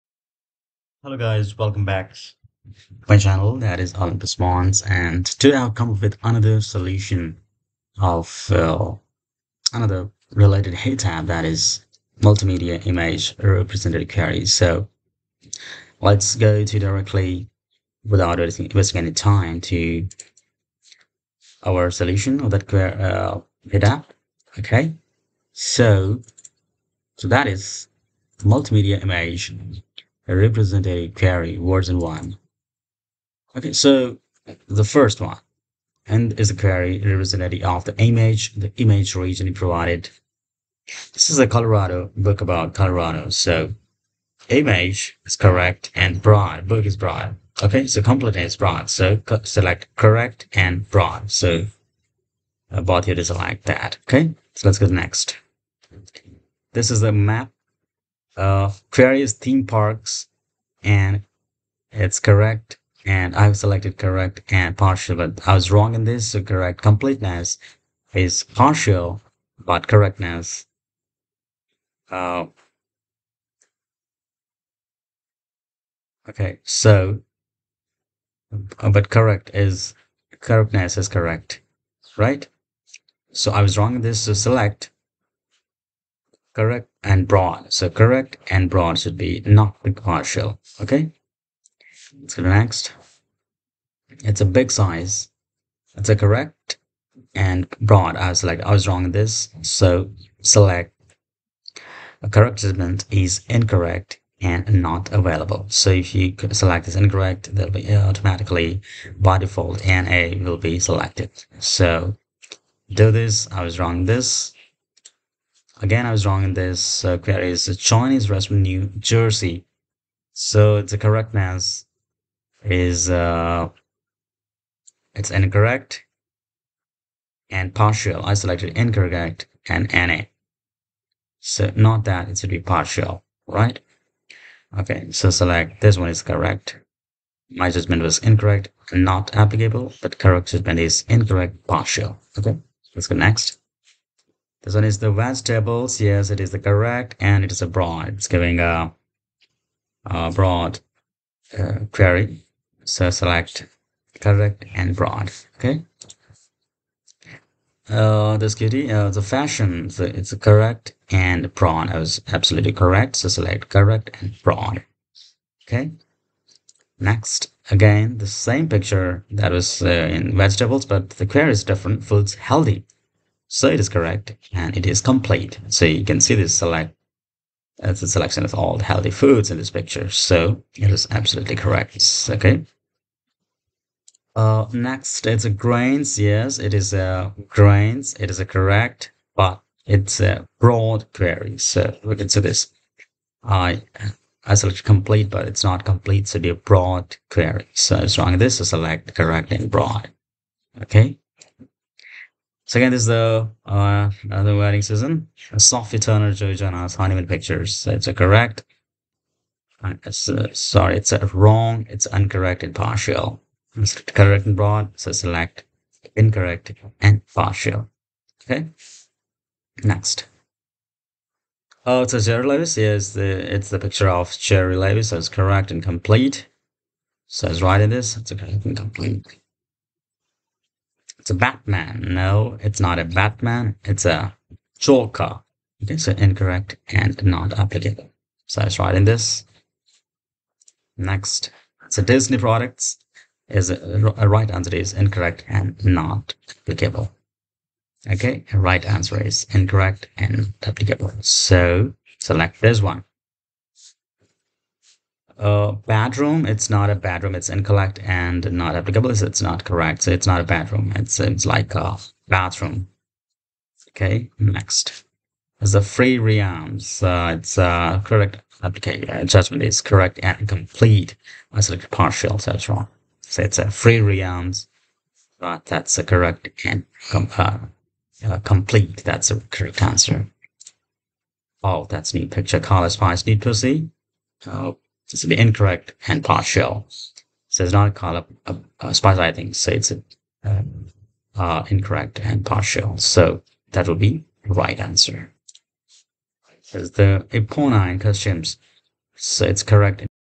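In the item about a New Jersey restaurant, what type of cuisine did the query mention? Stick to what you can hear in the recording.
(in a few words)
Chinese.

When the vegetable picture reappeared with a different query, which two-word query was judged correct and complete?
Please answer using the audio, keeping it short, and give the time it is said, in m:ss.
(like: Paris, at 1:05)
Foods healthy, at 2:52.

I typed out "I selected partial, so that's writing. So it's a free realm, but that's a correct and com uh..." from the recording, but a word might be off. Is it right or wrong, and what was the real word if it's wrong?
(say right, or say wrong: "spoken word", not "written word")
wrong: "wrong", not "writing".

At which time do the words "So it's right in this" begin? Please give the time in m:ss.
3:47.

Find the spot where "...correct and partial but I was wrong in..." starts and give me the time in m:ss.
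1:03.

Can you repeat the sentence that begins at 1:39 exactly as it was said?
So select a correct statement is incorrect and not available.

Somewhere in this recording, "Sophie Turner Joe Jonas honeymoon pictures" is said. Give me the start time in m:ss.
3:25.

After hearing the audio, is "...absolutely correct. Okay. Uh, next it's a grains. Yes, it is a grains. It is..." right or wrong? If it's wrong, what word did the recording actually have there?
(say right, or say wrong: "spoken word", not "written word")
right.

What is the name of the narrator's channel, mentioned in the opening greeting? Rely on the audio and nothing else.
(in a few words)
Olympus Mons.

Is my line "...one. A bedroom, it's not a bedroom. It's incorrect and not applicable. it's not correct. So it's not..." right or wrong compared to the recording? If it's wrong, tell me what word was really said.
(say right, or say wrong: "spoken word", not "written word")
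right.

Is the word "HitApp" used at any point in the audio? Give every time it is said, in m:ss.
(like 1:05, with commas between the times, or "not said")
0:10, 0:23.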